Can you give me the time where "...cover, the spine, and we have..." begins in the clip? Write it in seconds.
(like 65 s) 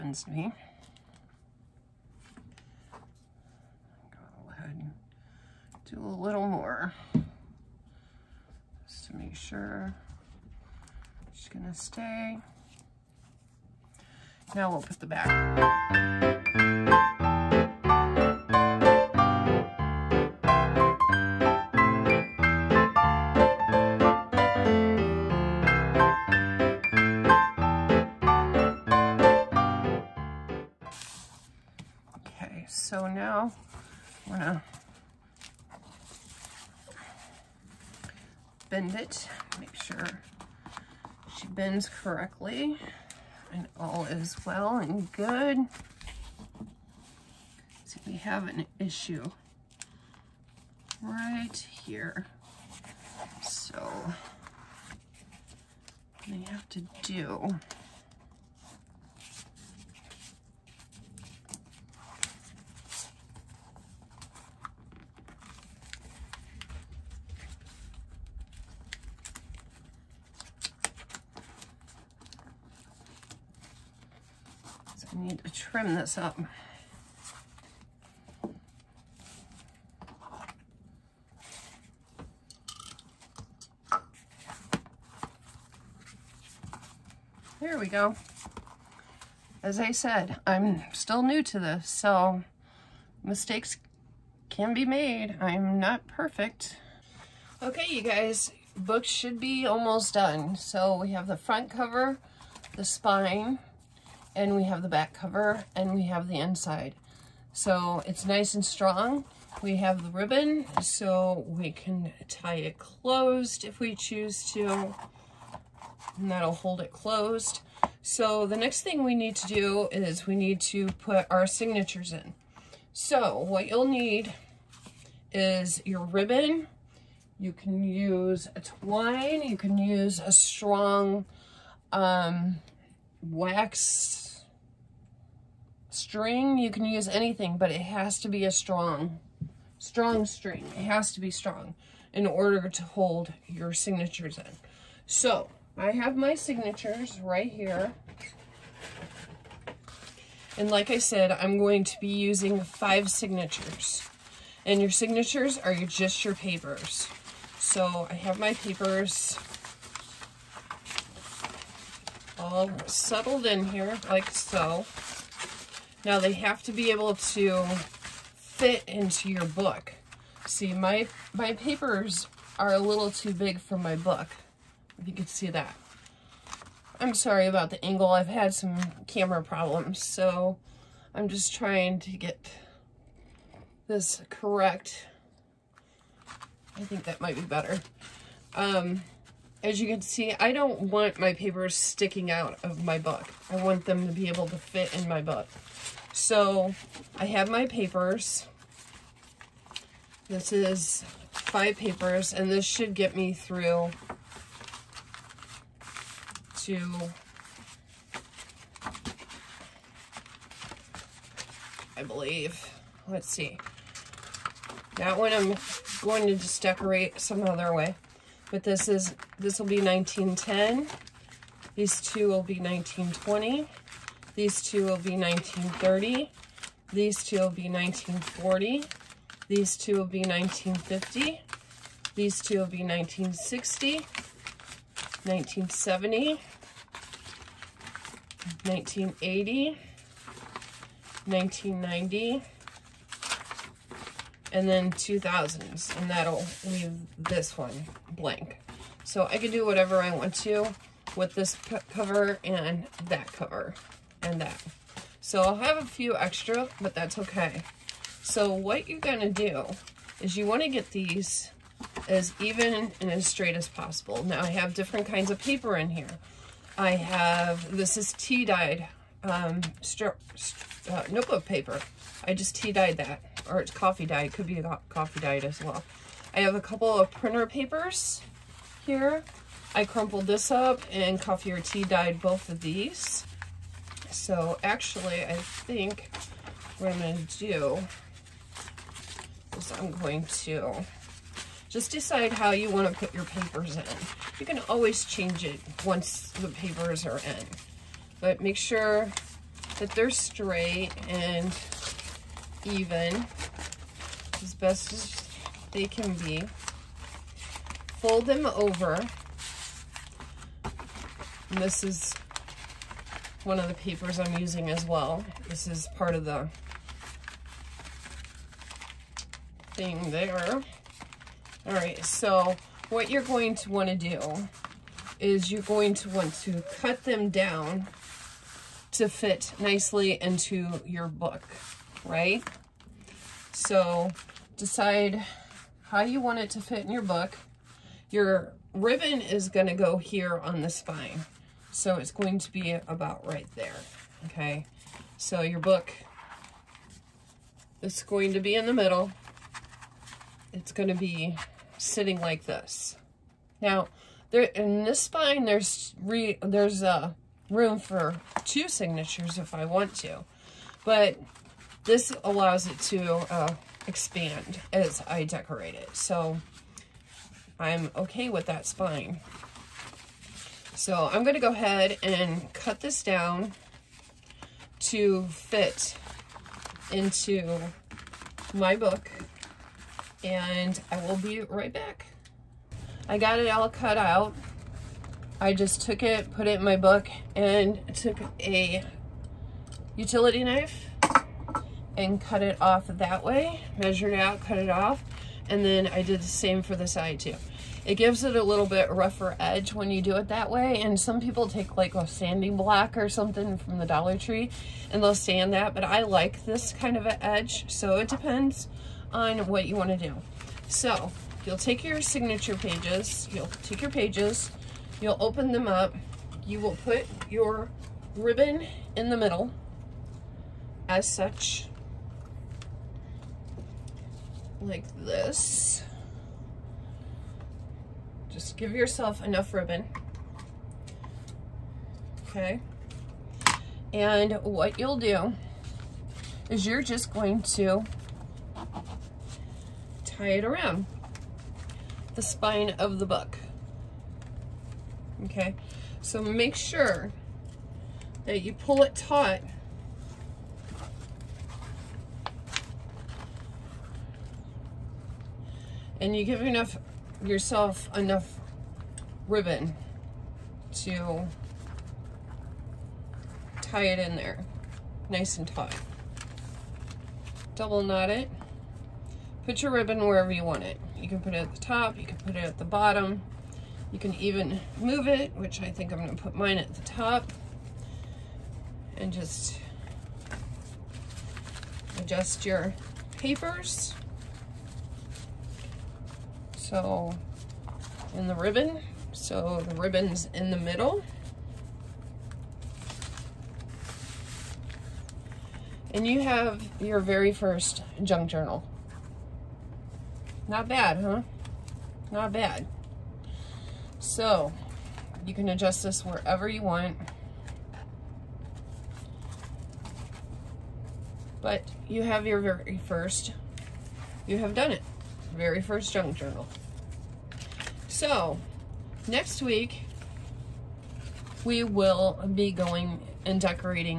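101 s.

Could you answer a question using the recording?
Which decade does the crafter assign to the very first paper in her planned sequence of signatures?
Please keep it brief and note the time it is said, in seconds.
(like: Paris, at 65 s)
1910, at 219 s.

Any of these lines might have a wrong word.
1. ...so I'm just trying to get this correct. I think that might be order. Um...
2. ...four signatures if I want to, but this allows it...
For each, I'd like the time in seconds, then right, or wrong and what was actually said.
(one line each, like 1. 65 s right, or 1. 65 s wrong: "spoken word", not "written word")
1. 180 s wrong: "better", not "order"
2. 358 s wrong: "two", not "four".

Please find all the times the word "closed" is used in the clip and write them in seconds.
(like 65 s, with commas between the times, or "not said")
112 s, 116 s.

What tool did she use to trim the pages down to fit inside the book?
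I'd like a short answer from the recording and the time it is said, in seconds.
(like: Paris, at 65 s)
utility knife, at 389 s.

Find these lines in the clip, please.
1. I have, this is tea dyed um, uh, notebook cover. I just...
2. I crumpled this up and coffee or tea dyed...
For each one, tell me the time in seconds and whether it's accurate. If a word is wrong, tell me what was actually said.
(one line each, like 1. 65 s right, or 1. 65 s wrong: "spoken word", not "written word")
1. 266 s wrong: "paper", not "cover"
2. 279 s right.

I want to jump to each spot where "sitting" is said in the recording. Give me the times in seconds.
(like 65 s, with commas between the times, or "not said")
351 s.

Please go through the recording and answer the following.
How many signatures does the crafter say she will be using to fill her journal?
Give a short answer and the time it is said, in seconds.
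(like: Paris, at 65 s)
5, at 152 s.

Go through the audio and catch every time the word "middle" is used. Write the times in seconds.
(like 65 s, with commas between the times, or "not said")
348 s, 419 s, 490 s.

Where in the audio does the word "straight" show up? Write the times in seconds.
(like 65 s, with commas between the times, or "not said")
263 s, 300 s.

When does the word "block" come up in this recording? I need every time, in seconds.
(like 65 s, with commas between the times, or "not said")
402 s.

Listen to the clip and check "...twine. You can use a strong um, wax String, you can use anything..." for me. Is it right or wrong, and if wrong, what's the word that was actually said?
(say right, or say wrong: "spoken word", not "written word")
right.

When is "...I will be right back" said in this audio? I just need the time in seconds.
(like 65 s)
380 s.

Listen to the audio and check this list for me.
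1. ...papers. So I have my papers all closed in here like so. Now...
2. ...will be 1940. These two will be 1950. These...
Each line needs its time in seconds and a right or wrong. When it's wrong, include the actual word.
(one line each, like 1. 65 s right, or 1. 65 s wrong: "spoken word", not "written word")
1. 156 s wrong: "settled", not "closed"
2. 227 s right.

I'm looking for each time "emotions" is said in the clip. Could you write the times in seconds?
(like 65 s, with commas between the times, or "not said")
not said.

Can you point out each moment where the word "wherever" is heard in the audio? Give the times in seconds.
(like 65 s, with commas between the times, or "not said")
469 s, 506 s.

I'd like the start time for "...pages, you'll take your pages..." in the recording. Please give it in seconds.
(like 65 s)
412 s.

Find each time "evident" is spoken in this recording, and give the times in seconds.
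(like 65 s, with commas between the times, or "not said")
not said.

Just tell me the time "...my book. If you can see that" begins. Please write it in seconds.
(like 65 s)
173 s.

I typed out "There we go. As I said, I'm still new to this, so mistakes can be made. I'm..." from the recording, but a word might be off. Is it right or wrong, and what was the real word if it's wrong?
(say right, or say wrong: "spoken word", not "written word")
right.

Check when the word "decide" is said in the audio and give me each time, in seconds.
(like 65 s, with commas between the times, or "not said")
291 s, 334 s.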